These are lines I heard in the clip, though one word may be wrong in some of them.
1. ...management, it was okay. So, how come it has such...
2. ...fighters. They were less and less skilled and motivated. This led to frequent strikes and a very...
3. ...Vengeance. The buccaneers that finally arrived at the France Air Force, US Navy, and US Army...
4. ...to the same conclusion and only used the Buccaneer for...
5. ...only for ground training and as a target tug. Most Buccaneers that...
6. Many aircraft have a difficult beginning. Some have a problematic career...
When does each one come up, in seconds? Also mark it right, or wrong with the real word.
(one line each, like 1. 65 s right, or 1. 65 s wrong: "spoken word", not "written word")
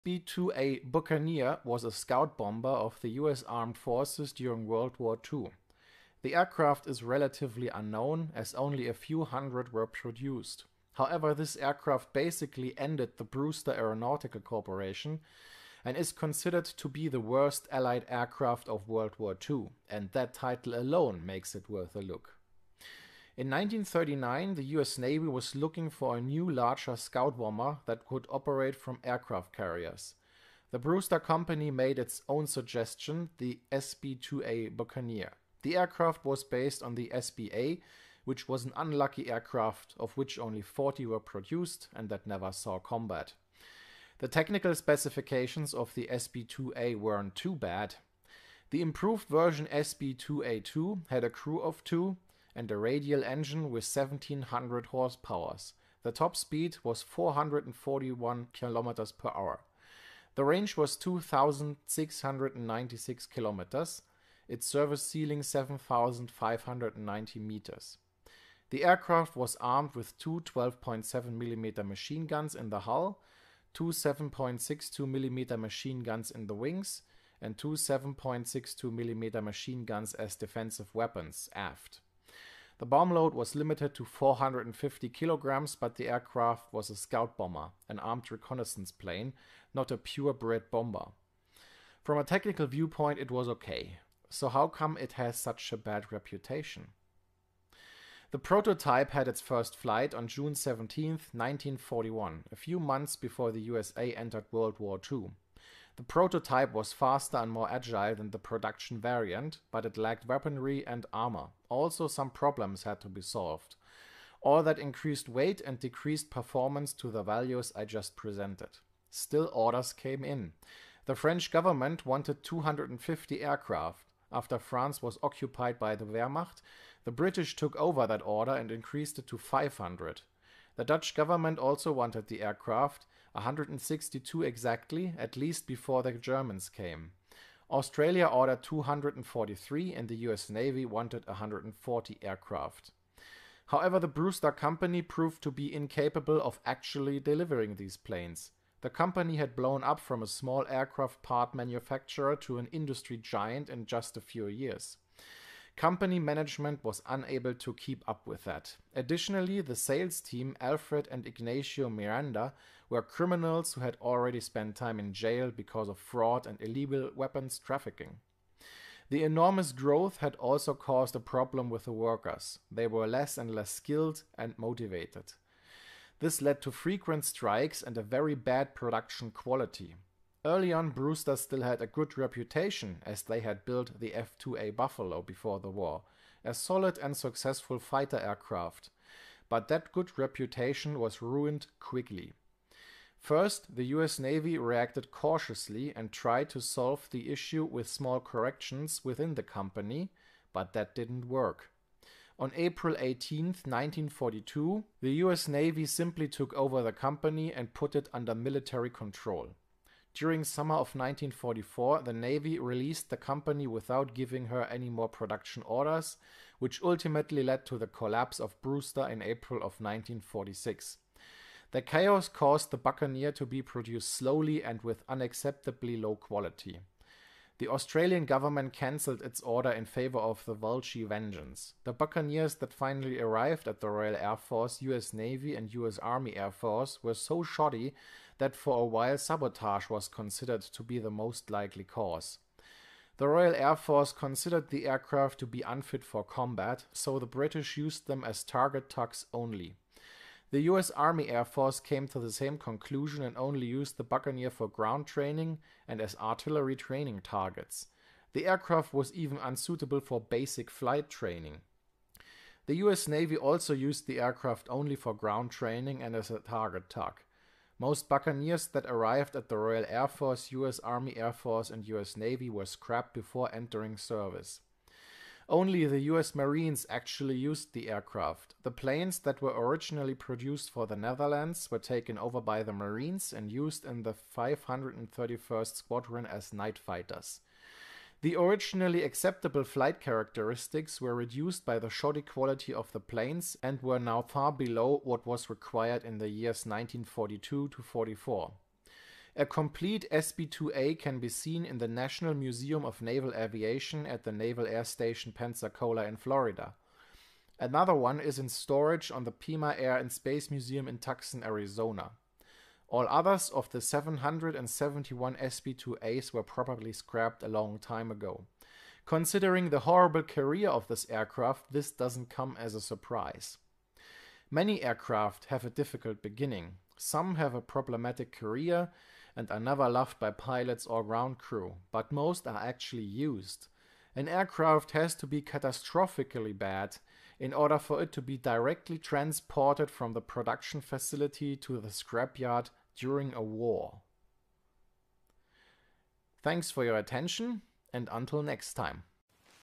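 1. 92 s wrong: "viewpoint", not "management"
2. 171 s wrong: "workers", not "fighters"
3. 231 s wrong: "Royal", not "France"
4. 252 s right
5. 264 s right
6. 324 s right.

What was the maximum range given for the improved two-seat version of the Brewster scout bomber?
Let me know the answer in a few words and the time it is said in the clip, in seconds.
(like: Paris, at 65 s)
2,696 kilometers, at 60 s.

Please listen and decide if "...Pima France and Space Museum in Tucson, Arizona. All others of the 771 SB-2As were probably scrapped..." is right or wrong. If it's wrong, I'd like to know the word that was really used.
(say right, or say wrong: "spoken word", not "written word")
wrong: "Air", not "France".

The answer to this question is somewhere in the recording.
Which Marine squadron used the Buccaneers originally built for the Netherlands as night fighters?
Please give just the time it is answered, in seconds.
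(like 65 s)
284 s.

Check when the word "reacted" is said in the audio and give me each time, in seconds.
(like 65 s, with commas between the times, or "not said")
194 s.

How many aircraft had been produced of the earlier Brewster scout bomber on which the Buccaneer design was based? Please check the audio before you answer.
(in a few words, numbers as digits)
40.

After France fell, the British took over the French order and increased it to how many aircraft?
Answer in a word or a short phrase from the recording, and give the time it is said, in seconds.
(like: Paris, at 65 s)
500, at 129 s.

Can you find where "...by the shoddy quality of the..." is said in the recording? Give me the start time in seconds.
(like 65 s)
291 s.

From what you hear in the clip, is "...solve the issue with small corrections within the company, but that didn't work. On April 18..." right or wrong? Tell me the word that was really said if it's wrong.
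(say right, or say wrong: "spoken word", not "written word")
right.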